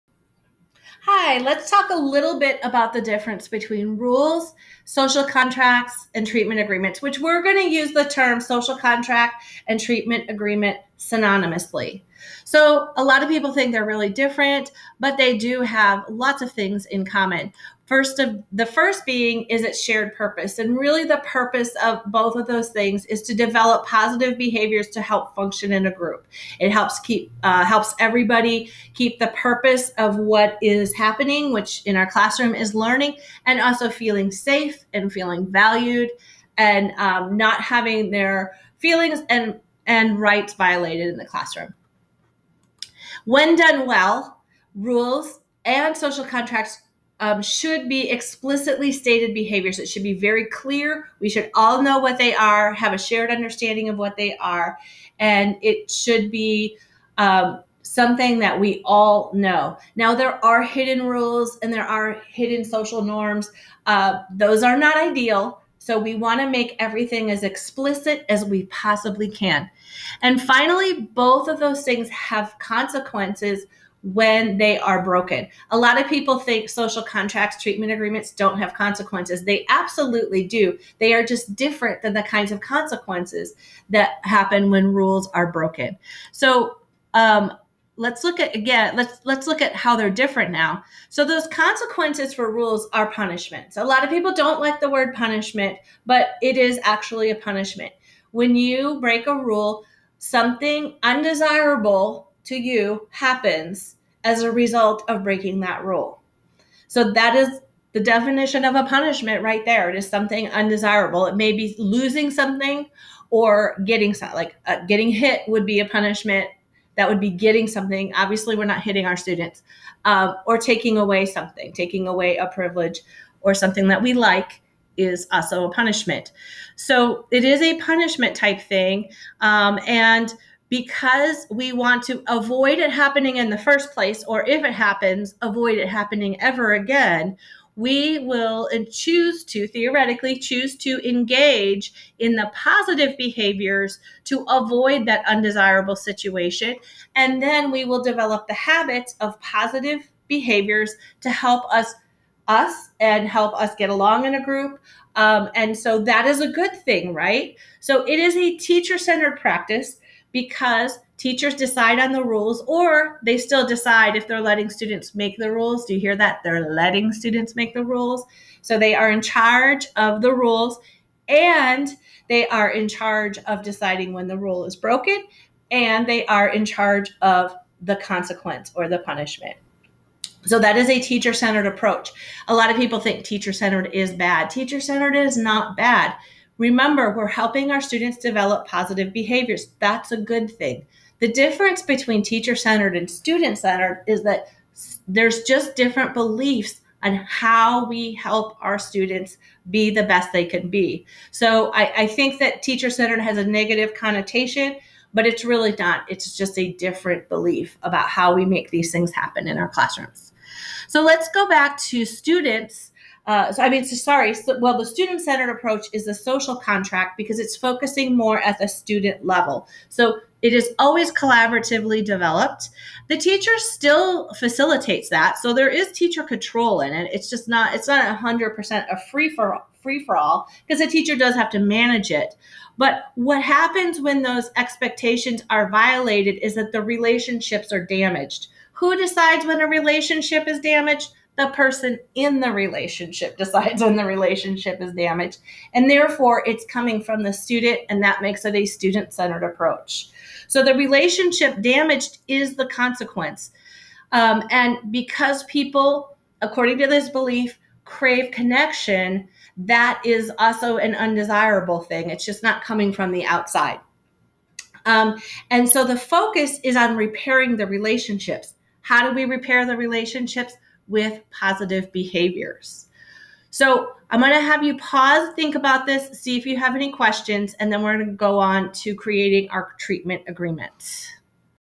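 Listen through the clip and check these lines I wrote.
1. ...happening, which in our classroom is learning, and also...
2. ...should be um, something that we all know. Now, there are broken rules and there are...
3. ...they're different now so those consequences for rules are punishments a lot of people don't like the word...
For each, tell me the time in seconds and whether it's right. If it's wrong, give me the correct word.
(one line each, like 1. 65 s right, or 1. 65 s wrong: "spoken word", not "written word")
1. 30 s right
2. 55 s wrong: "hidden", not "broken"
3. 89 s right.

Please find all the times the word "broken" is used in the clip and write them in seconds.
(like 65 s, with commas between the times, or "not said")
75 s, 85 s, 174 s.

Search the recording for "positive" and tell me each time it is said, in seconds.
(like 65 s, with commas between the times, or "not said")
23 s, 142 s, 149 s, 188 s, 271 s.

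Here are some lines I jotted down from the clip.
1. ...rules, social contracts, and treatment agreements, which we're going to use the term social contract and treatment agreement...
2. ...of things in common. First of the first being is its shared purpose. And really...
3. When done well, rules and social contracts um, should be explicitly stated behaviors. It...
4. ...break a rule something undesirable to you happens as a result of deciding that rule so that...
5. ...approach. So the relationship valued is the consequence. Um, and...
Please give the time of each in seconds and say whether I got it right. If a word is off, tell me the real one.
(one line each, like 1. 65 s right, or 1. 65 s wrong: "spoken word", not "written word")
1. 3 s right
2. 16 s right
3. 43 s right
4. 98 s wrong: "breaking", not "deciding"
5. 249 s wrong: "damaged", not "valued".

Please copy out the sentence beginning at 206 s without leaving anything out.
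It's just a different belief about how we make these things happen in our classrooms.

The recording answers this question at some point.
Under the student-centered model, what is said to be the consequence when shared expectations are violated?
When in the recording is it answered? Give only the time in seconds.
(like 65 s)
236 s.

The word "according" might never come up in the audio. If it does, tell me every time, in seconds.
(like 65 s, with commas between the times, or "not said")
256 s.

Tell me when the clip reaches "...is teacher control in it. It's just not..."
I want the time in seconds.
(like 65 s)
225 s.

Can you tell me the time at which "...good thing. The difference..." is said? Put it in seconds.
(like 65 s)
190 s.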